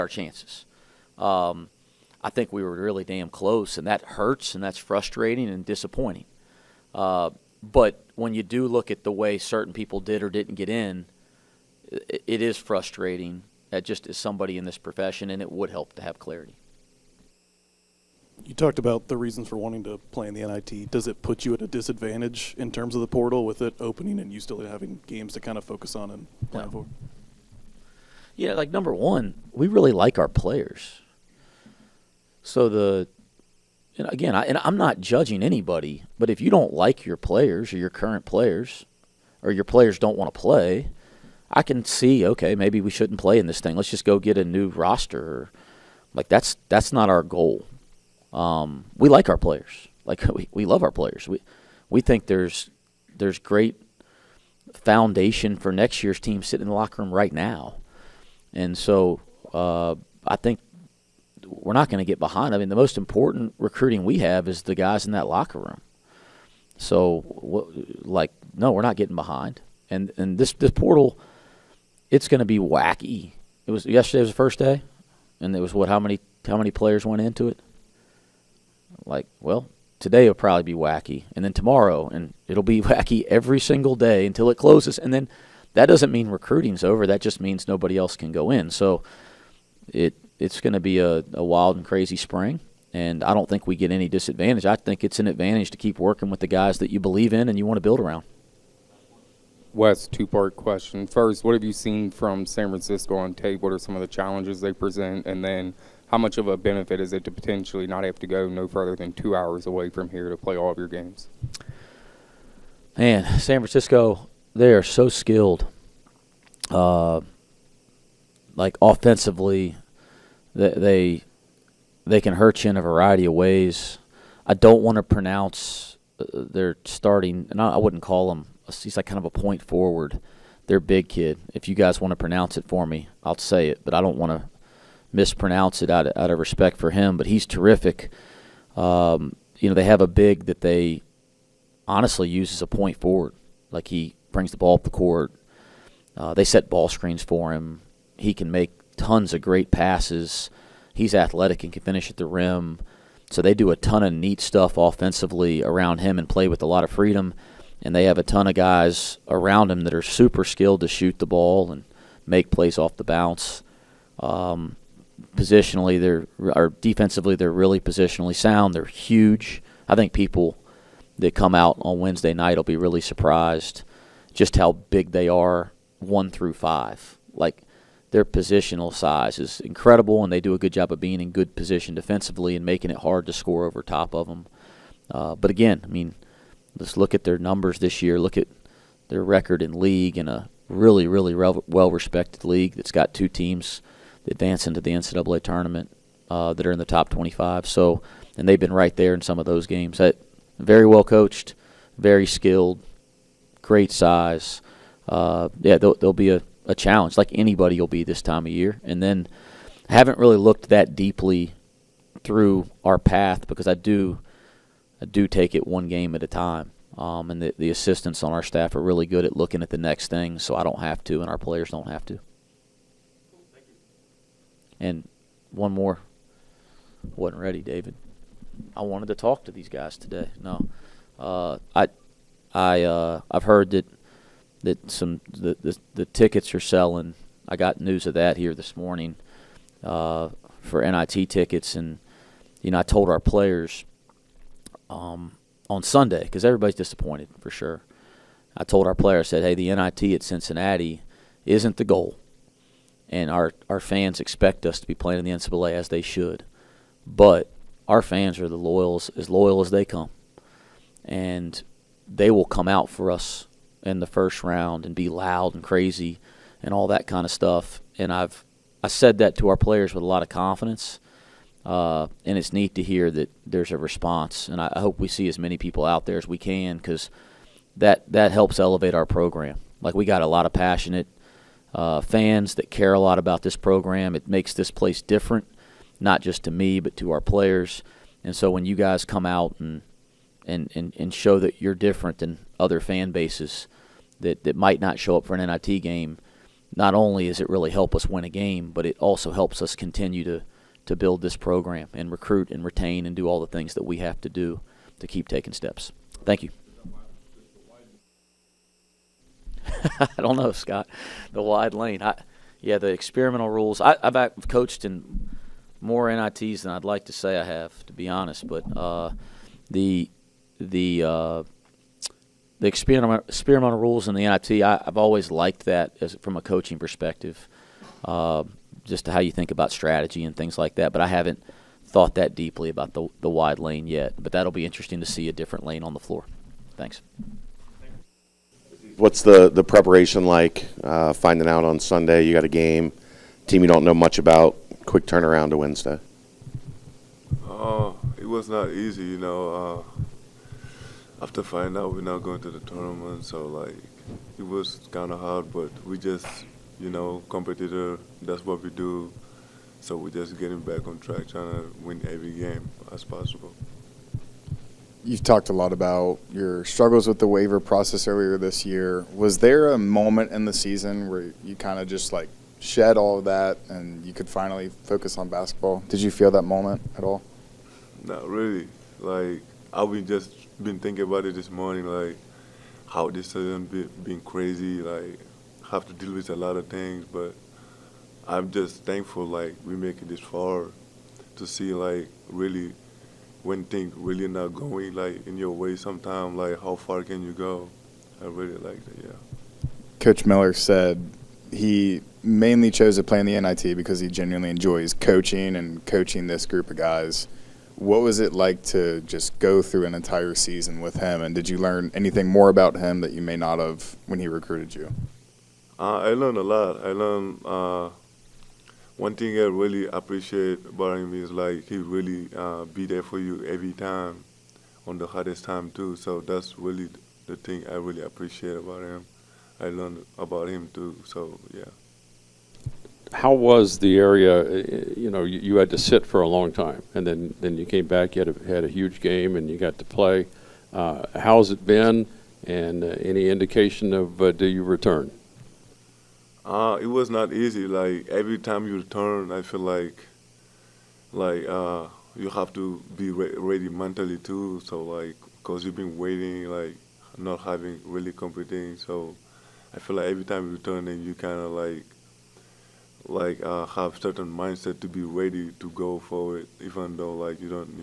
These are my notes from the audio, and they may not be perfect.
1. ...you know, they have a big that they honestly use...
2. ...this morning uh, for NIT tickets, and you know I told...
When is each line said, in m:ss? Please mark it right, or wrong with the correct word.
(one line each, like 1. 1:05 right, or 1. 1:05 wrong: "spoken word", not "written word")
1. 2:19 right
2. 3:58 right.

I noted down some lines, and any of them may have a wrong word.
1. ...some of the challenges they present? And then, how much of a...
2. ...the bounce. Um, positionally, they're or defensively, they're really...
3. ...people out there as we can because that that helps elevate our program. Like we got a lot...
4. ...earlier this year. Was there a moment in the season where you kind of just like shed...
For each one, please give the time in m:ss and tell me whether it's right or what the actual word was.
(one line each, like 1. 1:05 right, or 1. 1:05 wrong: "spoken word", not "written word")
1. 1:43 right
2. 2:42 right
3. 4:35 right
4. 6:08 right.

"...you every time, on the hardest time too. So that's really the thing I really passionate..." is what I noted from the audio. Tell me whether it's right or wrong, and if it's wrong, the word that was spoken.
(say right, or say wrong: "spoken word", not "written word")
wrong: "appreciate", not "passionate".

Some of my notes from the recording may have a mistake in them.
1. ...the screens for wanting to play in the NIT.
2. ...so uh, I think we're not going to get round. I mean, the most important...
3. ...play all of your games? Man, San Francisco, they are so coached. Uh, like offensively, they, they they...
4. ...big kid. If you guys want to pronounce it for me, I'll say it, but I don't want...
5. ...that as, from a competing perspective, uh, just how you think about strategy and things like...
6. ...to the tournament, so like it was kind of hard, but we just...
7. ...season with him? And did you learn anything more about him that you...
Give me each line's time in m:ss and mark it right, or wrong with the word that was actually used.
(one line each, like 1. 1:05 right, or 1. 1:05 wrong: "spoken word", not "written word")
1. 0:19 wrong: "reasons", not "screens"
2. 0:58 wrong: "behind", not "round"
3. 1:50 wrong: "skilled", not "coached"
4. 2:10 right
5. 5:25 wrong: "coaching", not "competing"
6. 5:52 right
7. 6:50 right.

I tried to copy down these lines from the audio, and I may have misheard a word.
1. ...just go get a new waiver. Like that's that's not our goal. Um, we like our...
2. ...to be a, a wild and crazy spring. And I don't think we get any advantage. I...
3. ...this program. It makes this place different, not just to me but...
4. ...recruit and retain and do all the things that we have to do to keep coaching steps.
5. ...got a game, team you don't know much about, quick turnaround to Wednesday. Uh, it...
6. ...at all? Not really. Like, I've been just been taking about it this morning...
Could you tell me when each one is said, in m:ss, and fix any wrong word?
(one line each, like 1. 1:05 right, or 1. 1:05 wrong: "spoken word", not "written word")
1. 0:43 wrong: "roster", not "waiver"
2. 1:30 wrong: "disadvantage", not "advantage"
3. 4:43 right
4. 5:02 wrong: "taking", not "coaching"
5. 5:42 right
6. 6:16 wrong: "thinking", not "taking".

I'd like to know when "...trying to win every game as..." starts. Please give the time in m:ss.
6:01.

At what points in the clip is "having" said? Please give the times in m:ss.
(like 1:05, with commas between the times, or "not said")
0:24, 7:37.